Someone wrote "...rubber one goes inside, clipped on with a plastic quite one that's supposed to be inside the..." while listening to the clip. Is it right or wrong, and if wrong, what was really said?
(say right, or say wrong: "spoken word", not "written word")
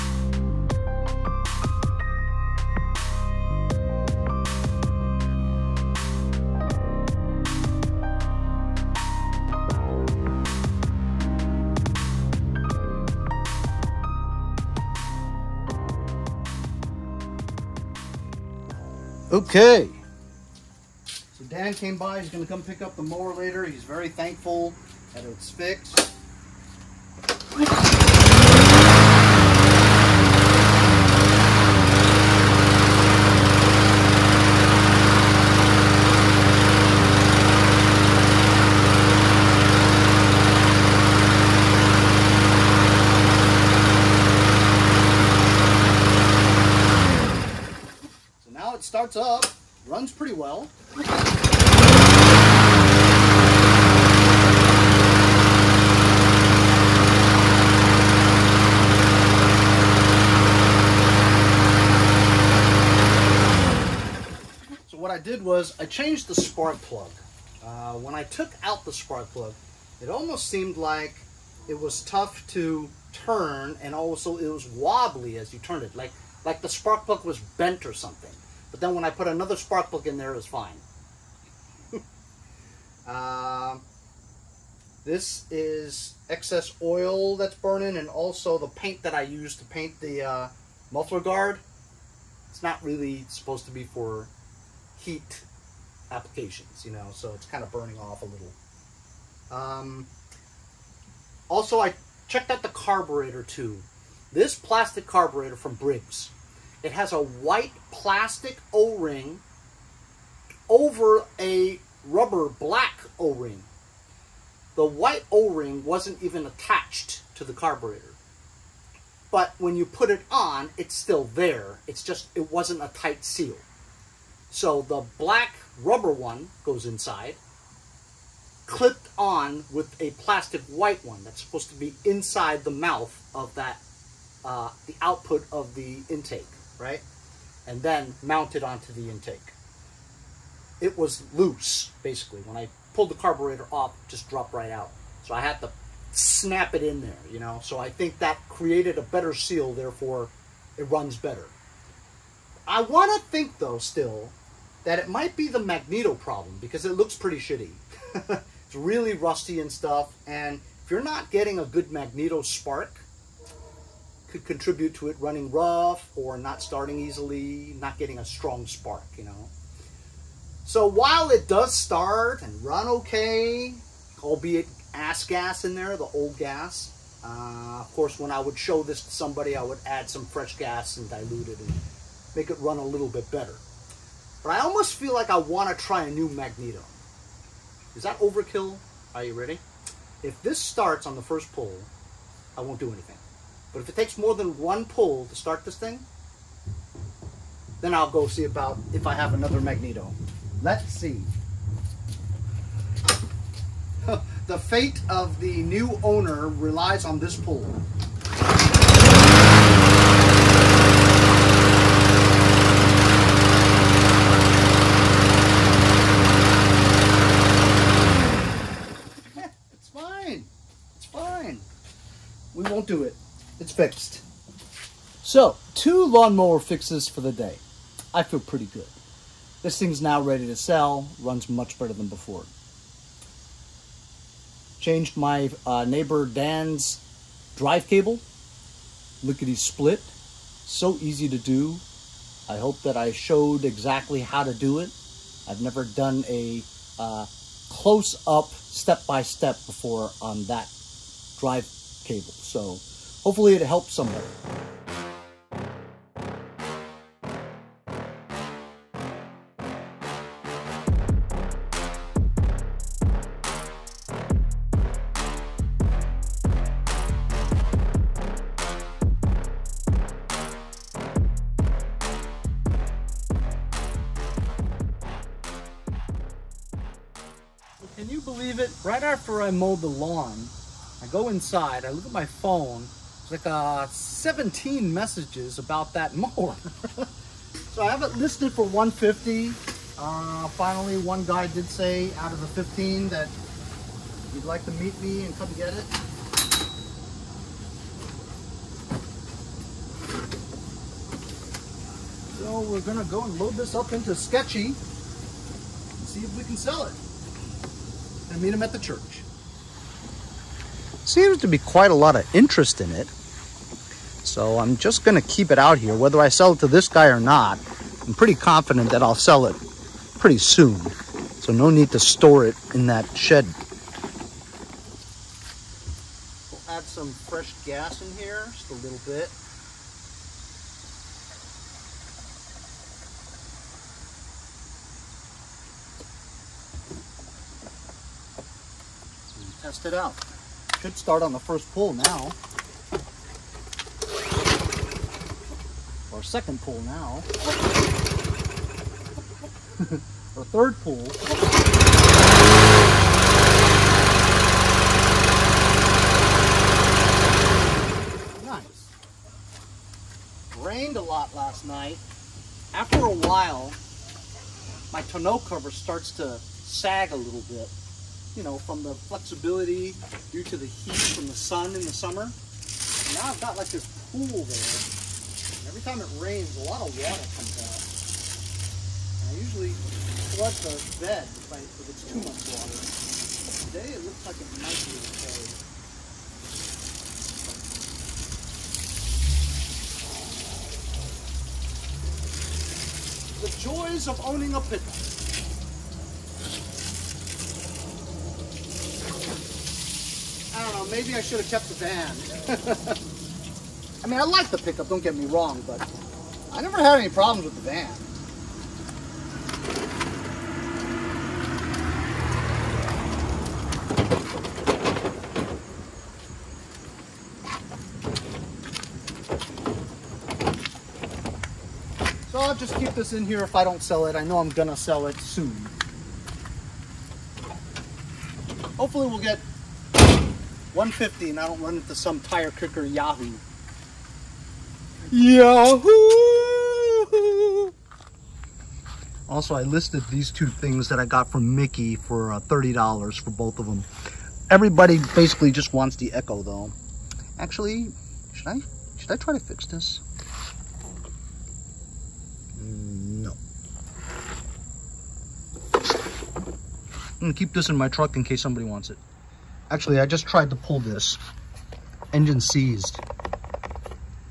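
wrong: "white", not "quite".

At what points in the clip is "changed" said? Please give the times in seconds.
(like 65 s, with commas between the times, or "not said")
65 s, 234 s.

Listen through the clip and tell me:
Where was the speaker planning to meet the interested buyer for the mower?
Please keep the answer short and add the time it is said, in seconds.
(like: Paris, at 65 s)
The church, at 308 s.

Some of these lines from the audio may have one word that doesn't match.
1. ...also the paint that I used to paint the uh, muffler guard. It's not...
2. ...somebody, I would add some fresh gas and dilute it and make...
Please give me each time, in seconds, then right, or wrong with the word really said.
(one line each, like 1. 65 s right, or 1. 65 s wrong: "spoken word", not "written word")
1. 88 s right
2. 179 s right.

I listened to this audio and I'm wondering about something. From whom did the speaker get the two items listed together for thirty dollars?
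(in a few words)
Mickey.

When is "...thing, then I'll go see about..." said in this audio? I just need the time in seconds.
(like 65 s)
195 s.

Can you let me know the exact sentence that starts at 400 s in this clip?
maybe I should have kept the van.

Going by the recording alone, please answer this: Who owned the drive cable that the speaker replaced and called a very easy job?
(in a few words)
Dan.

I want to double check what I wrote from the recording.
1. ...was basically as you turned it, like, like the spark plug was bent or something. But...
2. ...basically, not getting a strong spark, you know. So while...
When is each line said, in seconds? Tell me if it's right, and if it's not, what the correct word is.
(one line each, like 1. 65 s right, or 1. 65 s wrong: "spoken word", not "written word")
1. 74 s wrong: "wobbly", not "basically"
2. 166 s wrong: "easily", not "basically".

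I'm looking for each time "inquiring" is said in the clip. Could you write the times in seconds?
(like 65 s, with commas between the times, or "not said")
not said.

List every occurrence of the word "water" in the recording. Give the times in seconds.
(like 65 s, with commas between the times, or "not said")
376 s, 382 s.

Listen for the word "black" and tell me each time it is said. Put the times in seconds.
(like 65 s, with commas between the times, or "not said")
112 s, 125 s.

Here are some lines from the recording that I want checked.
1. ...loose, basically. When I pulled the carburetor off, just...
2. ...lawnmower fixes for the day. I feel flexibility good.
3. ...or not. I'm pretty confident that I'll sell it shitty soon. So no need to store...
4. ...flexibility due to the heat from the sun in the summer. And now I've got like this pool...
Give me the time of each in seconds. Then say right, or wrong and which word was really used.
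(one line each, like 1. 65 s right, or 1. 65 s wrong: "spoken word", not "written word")
1. 141 s right
2. 226 s wrong: "pretty", not "flexibility"
3. 317 s wrong: "pretty", not "shitty"
4. 368 s right.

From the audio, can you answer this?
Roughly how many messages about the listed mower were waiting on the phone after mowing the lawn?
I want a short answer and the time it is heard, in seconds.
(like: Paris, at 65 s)
17, at 283 s.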